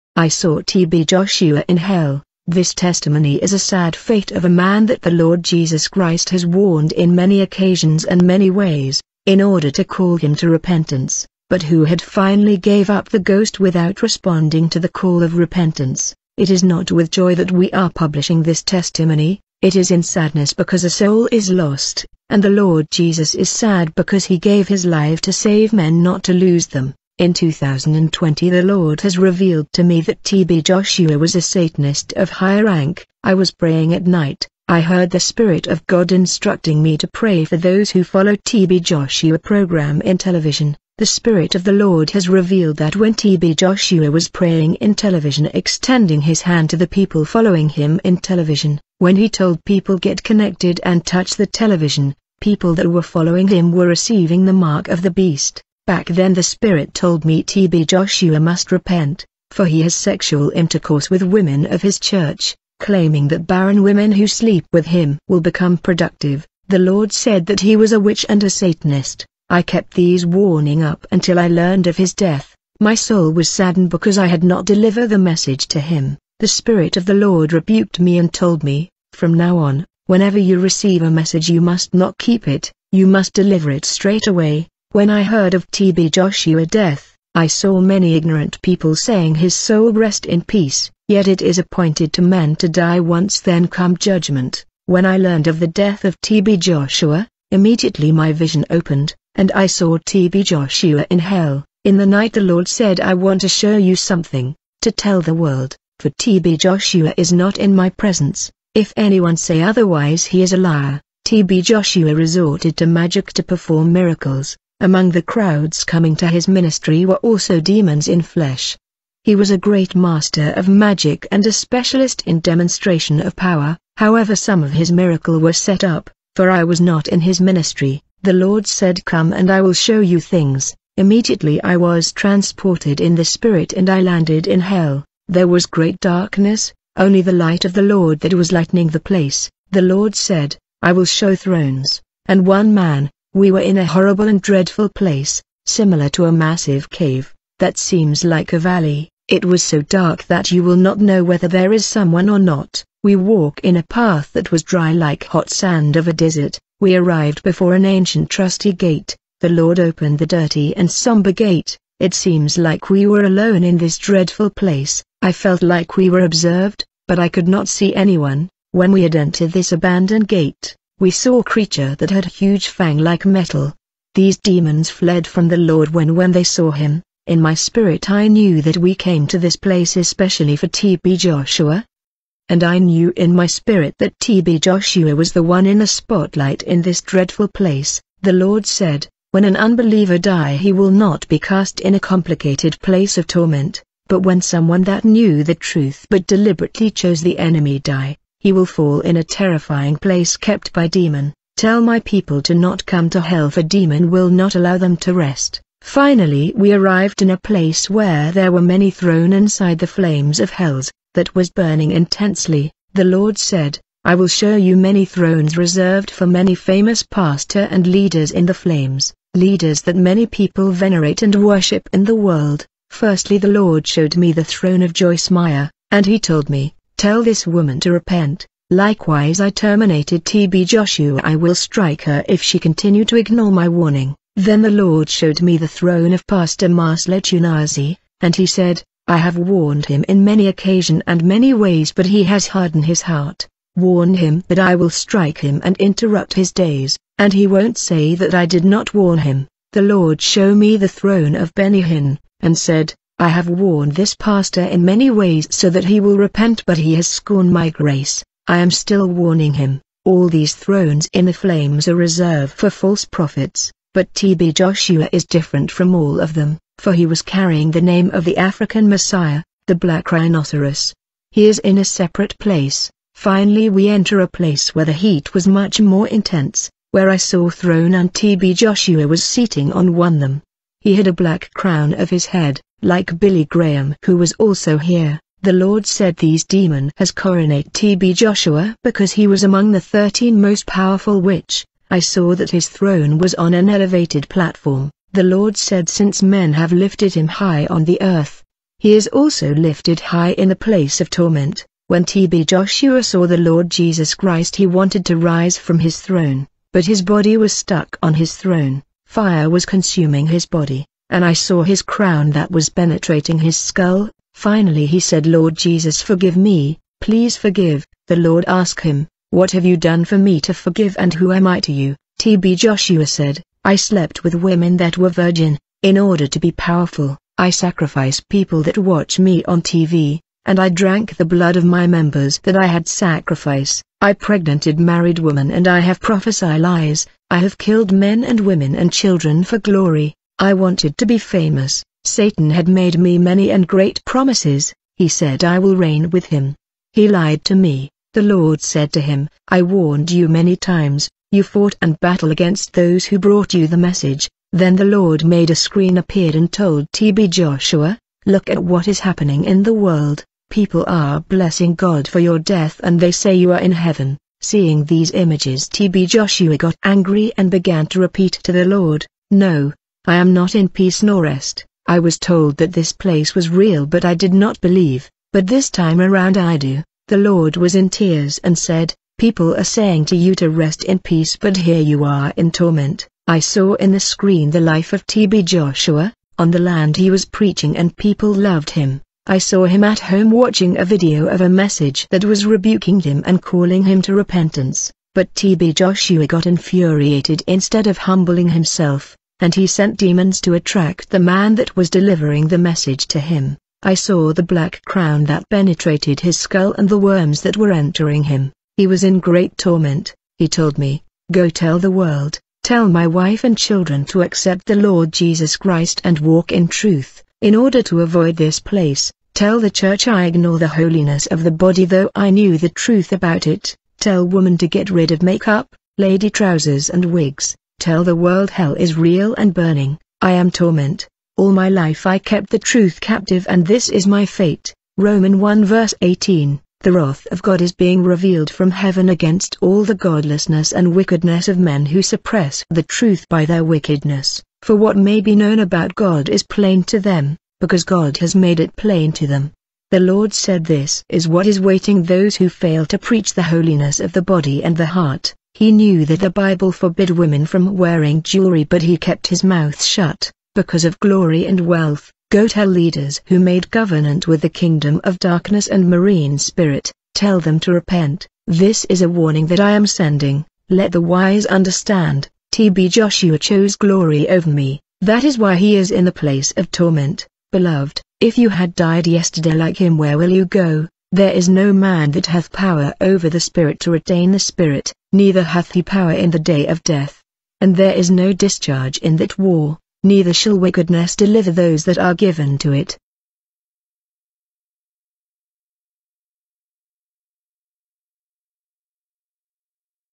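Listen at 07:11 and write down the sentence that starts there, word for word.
All my life I kept the truth captive and this is my fate.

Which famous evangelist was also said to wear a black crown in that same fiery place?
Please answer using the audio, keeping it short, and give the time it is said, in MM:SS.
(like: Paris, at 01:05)
Billy Graham, at 04:43.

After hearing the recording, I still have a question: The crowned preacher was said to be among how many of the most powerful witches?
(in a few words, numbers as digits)
13.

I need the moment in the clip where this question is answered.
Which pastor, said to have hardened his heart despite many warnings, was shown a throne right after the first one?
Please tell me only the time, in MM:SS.
03:56.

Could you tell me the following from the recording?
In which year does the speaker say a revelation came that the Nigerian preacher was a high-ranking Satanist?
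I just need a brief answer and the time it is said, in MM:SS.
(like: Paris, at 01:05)
2020, at 00:27.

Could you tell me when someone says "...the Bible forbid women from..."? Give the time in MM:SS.
07:36.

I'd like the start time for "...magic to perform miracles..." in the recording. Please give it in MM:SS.
01:52.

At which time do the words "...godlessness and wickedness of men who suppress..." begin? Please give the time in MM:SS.
07:19.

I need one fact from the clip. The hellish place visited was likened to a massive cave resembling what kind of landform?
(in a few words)
A valley.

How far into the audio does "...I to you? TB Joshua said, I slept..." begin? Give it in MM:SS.
05:21.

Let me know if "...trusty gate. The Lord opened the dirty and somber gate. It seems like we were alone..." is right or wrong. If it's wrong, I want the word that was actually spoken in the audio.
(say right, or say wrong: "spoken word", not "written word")
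right.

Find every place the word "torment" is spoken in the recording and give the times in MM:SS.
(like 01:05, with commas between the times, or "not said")
03:13, 05:01, 06:22, 06:49, 07:10, 07:56.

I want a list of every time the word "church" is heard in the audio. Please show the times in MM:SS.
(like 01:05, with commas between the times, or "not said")
01:01, 06:59.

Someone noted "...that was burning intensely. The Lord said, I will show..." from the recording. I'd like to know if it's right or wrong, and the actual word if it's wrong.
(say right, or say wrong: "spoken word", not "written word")
right.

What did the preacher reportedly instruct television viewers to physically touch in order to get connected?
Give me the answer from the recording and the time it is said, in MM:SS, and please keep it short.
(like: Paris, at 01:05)
The television, at 00:51.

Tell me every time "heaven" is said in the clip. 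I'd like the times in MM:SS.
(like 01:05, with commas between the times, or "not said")
06:03, 07:18.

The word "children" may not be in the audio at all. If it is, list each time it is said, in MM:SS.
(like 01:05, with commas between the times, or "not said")
05:38, 06:53.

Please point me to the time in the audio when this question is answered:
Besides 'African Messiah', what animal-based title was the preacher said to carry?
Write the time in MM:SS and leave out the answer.
04:29.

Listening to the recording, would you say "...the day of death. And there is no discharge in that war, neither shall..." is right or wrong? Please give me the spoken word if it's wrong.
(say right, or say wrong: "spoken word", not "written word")
right.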